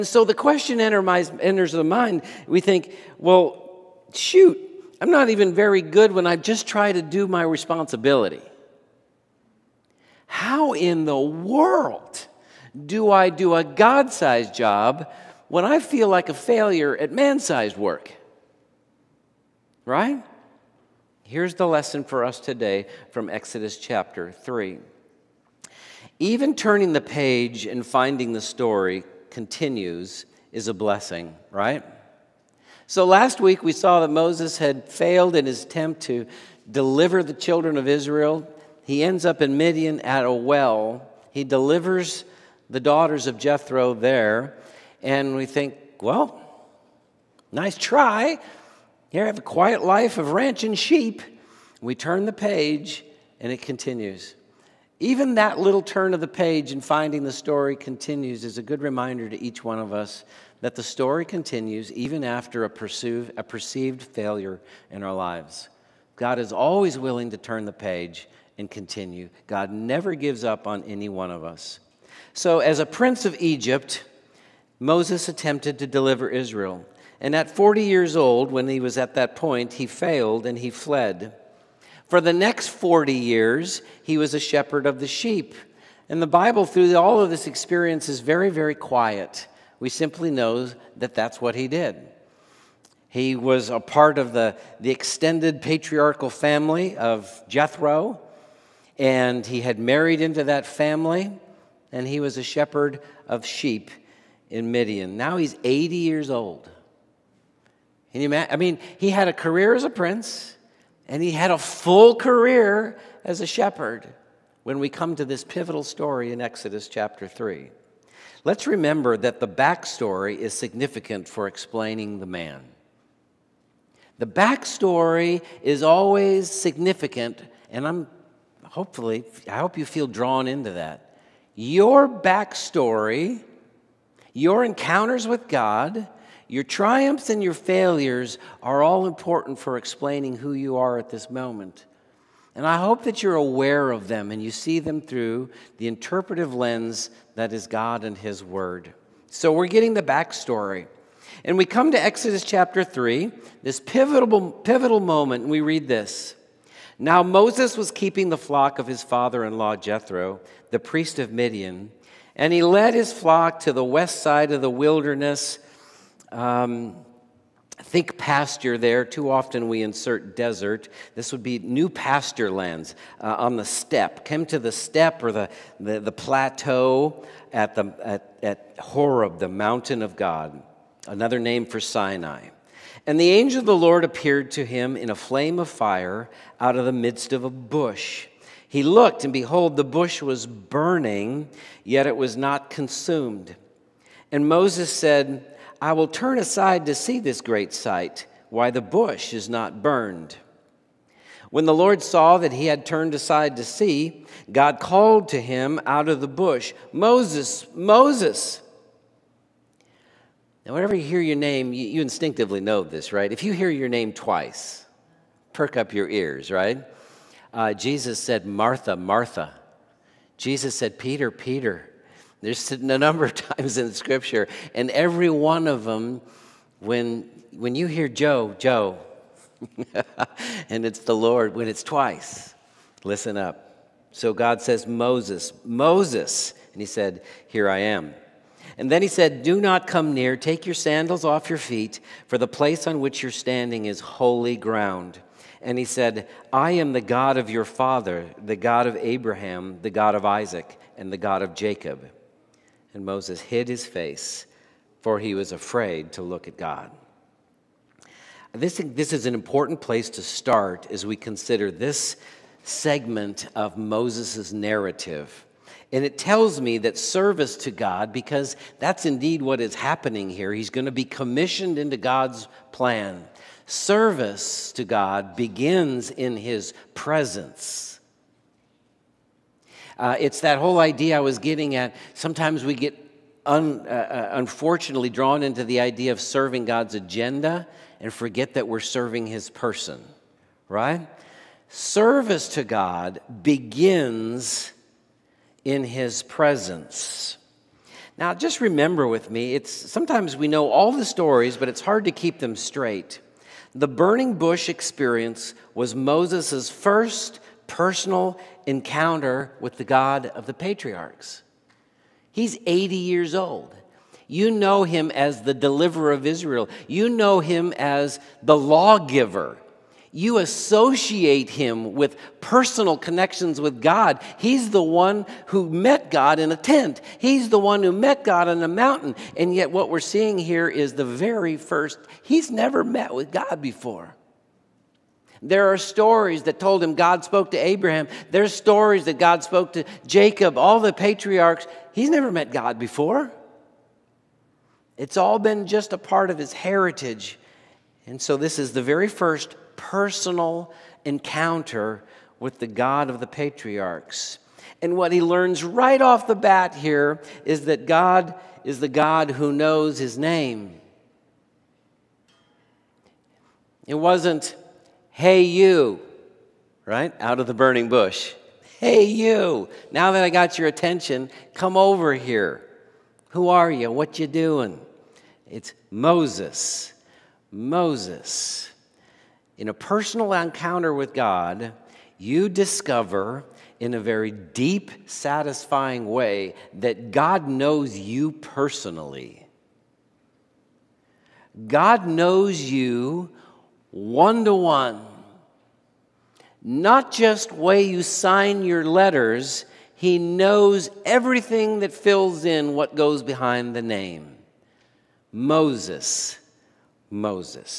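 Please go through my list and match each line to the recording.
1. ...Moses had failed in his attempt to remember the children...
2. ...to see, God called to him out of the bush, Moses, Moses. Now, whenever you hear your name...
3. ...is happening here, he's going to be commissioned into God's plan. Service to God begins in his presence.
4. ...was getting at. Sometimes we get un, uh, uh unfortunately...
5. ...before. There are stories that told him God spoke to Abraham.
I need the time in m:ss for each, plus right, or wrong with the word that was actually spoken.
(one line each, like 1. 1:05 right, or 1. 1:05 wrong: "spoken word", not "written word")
1. 0:34 wrong: "deliver", not "remember"
2. 3:23 right
3. 4:29 right
4. 4:41 right
5. 5:33 right.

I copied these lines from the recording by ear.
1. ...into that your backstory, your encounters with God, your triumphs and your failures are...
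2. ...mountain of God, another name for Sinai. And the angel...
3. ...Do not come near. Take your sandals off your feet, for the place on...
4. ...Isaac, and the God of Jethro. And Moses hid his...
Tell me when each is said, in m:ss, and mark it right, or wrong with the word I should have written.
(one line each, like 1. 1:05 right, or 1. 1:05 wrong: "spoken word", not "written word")
1. 2:10 right
2. 2:59 right
3. 3:59 right
4. 4:10 wrong: "Jacob", not "Jethro".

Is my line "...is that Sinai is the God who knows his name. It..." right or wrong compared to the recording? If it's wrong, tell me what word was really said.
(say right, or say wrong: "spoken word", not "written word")
wrong: "God", not "Sinai".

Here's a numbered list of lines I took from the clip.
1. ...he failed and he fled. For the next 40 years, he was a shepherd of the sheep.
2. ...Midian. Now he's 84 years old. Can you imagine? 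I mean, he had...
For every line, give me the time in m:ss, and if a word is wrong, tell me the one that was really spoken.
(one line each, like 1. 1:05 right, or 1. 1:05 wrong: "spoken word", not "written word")
1. 1:19 right
2. 1:44 wrong: "80", not "84".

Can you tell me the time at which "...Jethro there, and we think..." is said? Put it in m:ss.
0:43.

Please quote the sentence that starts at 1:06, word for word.
God is always willing to turn the page and continue.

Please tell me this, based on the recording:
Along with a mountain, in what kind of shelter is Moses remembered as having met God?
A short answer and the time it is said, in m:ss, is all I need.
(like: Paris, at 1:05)
A tent, at 5:26.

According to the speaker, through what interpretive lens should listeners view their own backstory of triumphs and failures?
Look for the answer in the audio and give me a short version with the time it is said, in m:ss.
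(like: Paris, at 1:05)
God and His Word, at 2:27.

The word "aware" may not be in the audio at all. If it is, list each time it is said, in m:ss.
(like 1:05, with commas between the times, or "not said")
2:23.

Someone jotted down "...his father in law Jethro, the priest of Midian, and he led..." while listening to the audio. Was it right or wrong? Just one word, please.
right.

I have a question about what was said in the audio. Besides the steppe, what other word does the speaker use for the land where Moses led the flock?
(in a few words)
Plateau.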